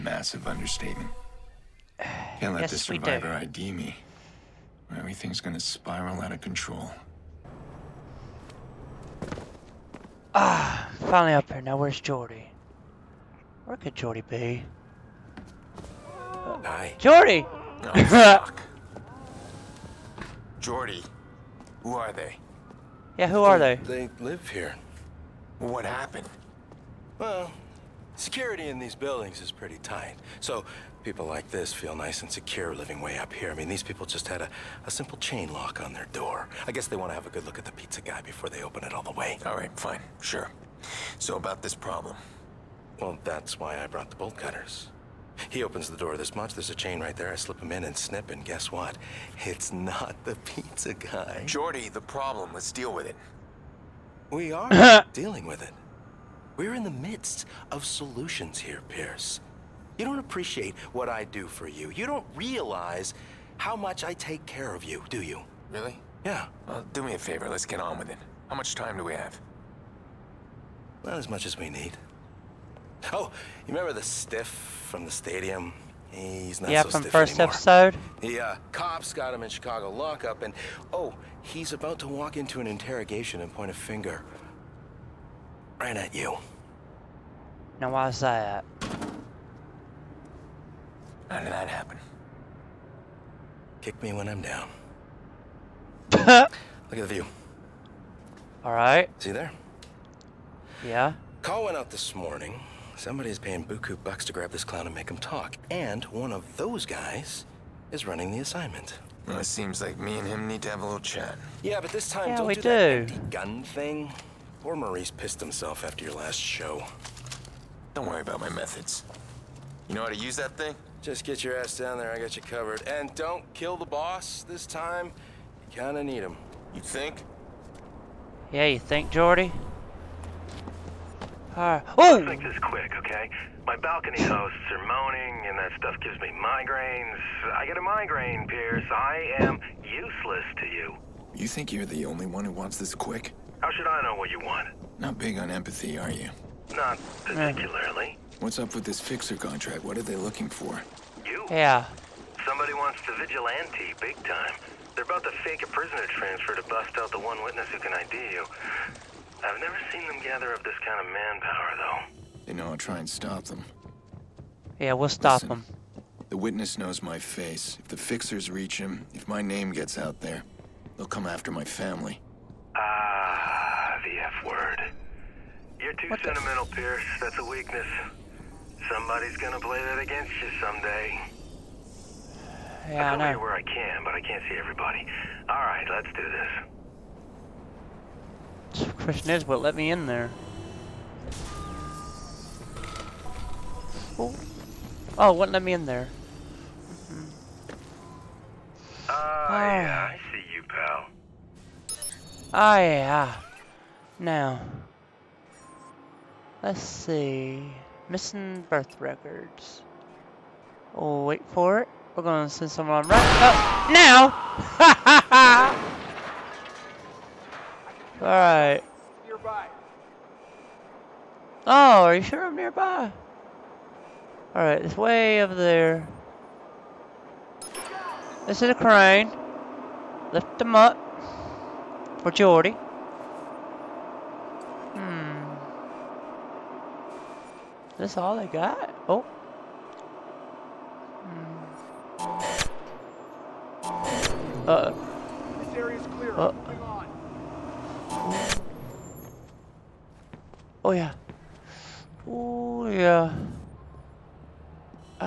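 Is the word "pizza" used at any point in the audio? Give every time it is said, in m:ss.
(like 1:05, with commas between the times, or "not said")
0:37, 0:50.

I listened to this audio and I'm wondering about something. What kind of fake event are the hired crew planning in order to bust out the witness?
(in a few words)
prisoner transfer.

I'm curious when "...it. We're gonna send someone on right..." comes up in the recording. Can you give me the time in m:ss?
3:31.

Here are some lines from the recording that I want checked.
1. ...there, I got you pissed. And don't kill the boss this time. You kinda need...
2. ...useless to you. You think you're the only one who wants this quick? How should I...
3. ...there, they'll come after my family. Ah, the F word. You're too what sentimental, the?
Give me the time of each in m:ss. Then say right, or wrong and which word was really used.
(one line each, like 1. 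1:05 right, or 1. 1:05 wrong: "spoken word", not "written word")
1. 2:01 wrong: "covered", not "pissed"
2. 2:19 right
3. 2:50 right.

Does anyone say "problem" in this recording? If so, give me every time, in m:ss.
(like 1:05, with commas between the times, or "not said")
0:41, 0:52.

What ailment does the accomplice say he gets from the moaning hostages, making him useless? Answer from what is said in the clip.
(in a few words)
migraines.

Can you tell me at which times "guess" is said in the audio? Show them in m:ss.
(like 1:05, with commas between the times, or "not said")
0:36, 0:48.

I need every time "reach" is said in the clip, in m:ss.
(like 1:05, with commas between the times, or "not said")
2:48.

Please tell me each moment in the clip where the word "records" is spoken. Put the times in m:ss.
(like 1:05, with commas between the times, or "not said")
3:28.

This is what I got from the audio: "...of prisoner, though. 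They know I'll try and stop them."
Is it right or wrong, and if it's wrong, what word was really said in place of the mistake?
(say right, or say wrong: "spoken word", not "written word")
wrong: "manpower", not "prisoner".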